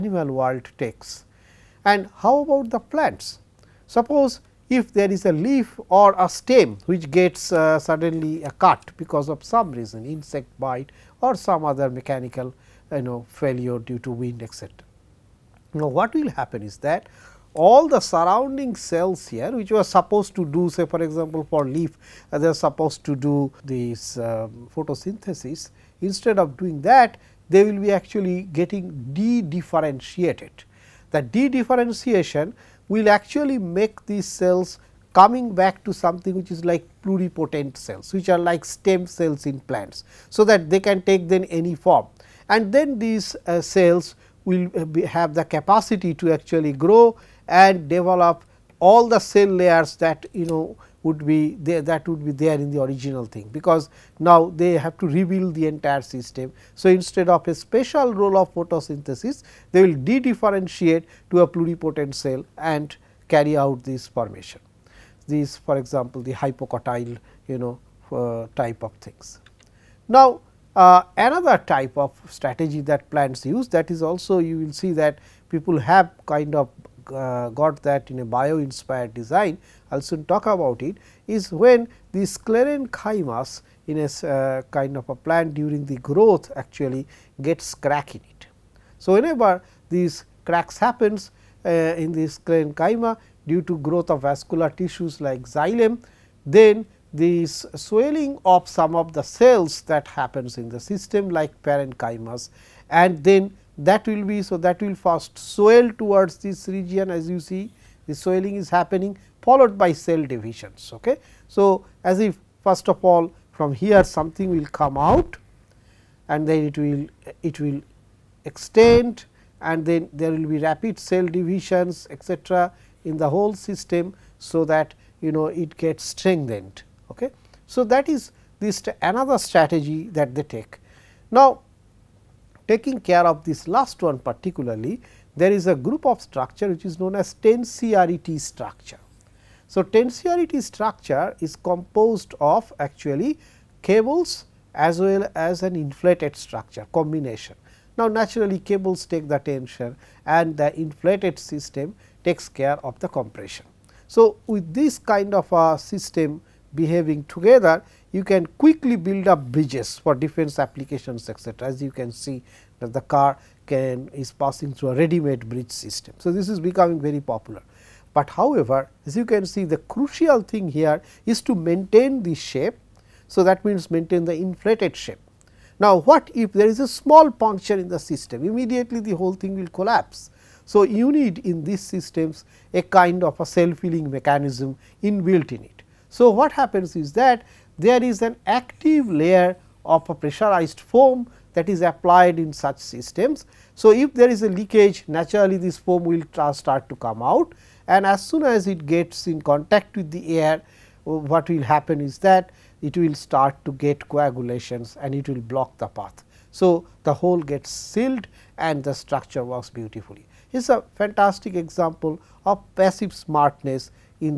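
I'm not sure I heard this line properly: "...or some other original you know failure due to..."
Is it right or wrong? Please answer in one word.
wrong.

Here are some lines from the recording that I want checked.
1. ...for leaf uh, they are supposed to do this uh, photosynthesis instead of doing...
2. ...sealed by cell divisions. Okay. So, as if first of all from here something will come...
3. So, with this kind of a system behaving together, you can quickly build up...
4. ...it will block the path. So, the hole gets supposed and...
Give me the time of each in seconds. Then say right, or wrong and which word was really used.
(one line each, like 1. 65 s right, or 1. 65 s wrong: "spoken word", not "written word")
1. 21 s right
2. 109 s wrong: "followed", not "sealed"
3. 154 s right
4. 205 s wrong: "sealed", not "supposed".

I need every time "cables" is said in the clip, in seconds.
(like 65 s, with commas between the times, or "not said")
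143 s, 148 s.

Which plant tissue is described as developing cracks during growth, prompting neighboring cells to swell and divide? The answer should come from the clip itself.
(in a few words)
sclerenchyma.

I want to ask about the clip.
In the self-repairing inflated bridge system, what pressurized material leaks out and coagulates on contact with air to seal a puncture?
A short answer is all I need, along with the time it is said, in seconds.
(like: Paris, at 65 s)
pressurized foam, at 190 s.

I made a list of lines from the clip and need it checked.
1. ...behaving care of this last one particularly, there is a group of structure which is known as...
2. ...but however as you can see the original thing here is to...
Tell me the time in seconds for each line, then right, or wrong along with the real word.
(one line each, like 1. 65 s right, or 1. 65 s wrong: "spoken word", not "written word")
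1. 132 s wrong: "taking", not "behaving"
2. 168 s wrong: "crucial", not "original".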